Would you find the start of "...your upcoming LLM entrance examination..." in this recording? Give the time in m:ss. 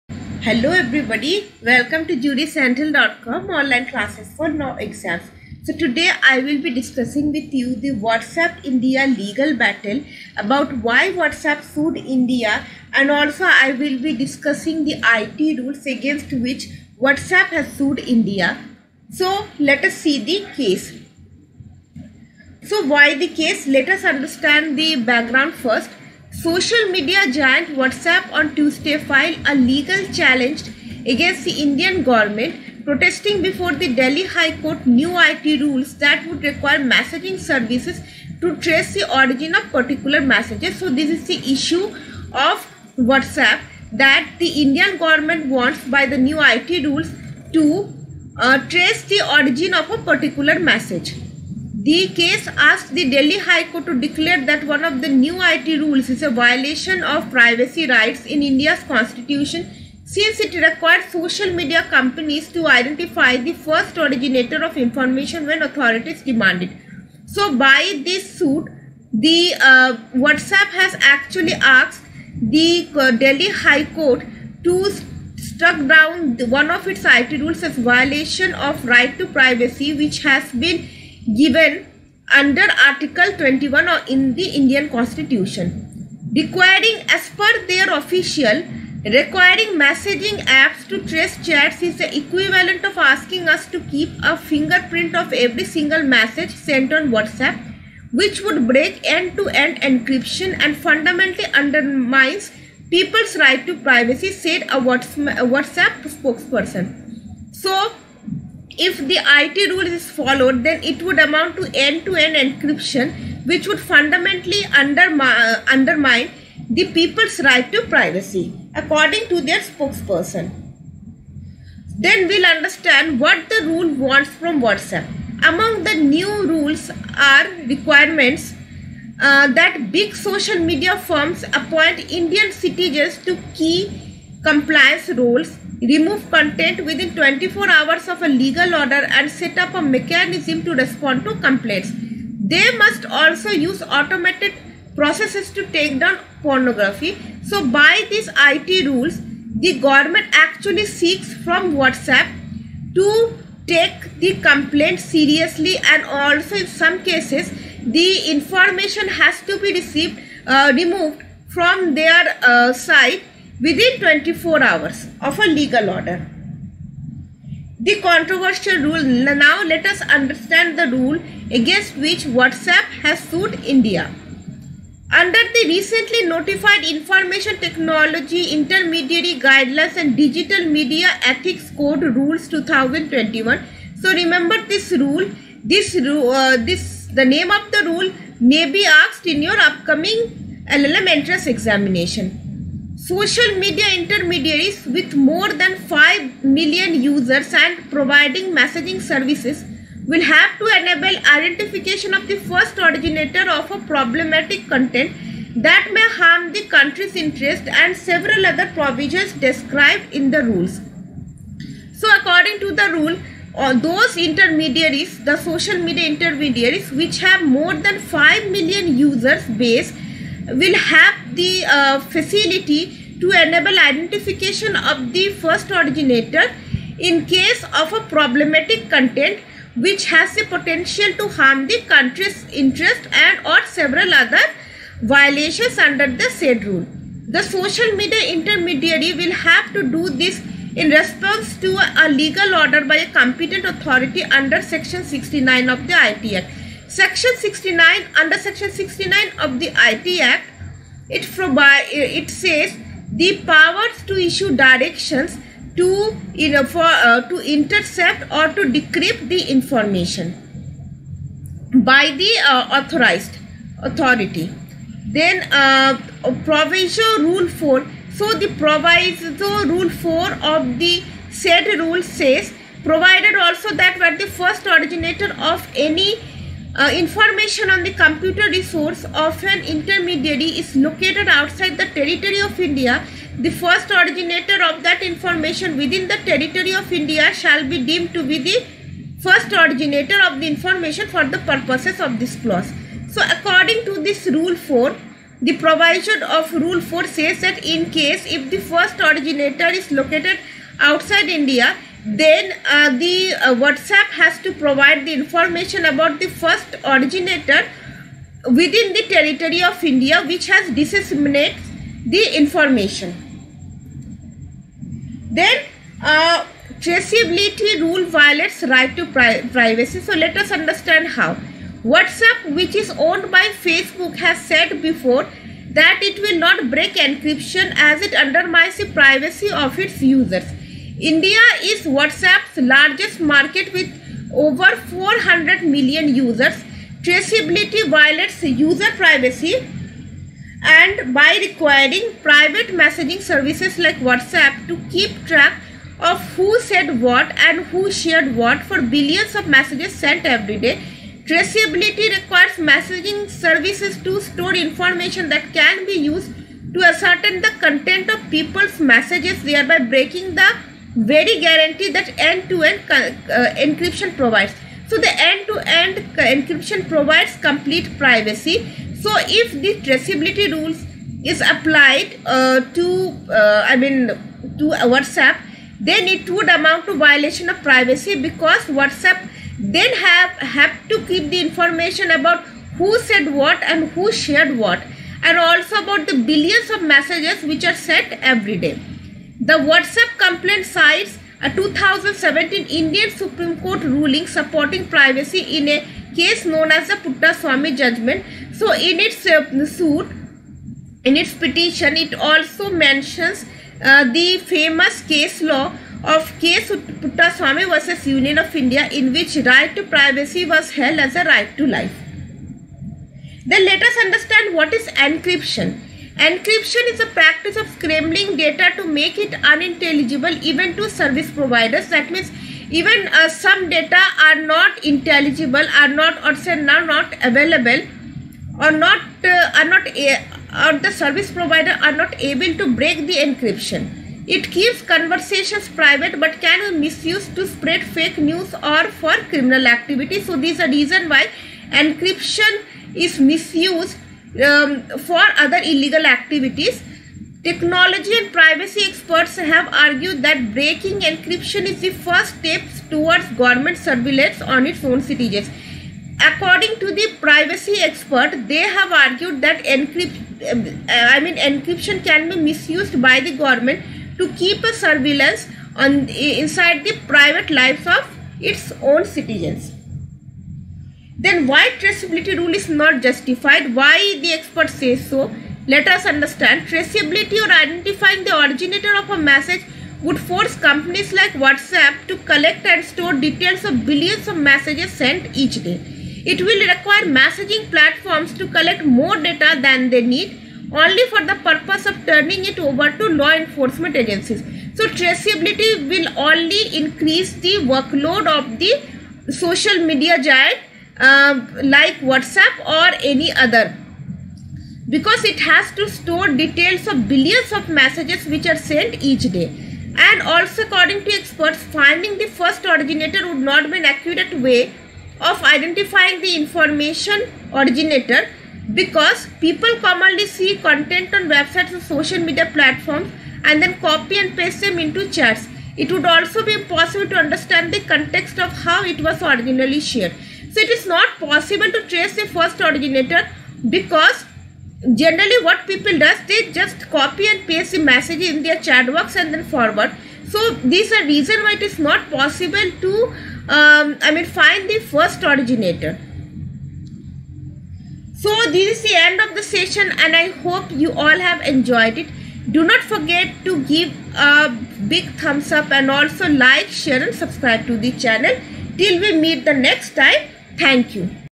3:09.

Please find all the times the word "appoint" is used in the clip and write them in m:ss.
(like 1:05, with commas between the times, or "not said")
2:11.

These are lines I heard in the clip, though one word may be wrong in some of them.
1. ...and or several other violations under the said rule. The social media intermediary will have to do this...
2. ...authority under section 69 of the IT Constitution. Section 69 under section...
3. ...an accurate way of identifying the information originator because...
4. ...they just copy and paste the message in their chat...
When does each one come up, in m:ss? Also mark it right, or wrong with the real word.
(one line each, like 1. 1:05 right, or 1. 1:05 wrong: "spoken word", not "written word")
1. 3:53 right
2. 4:03 wrong: "Act", not "Constitution"
3. 8:33 right
4. 8:56 right.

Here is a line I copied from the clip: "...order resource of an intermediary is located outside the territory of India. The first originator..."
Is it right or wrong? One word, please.
wrong.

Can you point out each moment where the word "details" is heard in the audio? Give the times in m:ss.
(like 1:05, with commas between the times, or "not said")
8:03, 8:26.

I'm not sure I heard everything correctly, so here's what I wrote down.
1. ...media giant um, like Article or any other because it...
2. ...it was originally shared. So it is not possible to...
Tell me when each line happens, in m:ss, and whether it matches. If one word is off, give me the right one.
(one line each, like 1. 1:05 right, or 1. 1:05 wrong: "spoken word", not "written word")
1. 8:19 wrong: "WhatsApp", not "Article"
2. 8:48 right.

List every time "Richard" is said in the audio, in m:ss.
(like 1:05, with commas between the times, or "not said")
not said.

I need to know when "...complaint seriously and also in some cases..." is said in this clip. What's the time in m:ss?
2:34.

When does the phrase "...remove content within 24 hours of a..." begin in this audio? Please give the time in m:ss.
2:15.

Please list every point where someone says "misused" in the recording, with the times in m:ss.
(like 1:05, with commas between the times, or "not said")
7:16, 7:23, 7:42.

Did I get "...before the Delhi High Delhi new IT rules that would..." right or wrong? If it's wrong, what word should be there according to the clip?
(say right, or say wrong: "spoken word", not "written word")
wrong: "Court", not "Delhi".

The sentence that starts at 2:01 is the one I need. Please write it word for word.
Then we'll understand what the rule wants from WhatsApp.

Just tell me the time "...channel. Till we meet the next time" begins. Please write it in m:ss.
9:17.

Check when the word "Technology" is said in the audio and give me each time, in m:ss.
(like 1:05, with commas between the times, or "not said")
2:57, 7:27.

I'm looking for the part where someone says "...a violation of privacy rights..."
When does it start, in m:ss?
0:56.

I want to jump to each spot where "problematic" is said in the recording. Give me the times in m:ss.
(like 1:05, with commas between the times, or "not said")
3:23, 3:48.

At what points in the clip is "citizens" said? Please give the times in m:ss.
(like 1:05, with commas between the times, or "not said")
2:12, 7:35, 7:49.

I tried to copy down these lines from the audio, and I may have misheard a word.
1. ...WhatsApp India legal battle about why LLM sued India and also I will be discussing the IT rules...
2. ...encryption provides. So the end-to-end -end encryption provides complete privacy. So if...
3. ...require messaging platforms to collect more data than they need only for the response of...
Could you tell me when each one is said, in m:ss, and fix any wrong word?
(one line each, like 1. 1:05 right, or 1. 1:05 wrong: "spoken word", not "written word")
1. 0:08 wrong: "WhatsApp", not "LLM"
2. 6:03 right
3. 8:06 wrong: "purpose", not "response".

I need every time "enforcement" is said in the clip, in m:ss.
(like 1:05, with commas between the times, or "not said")
8:13.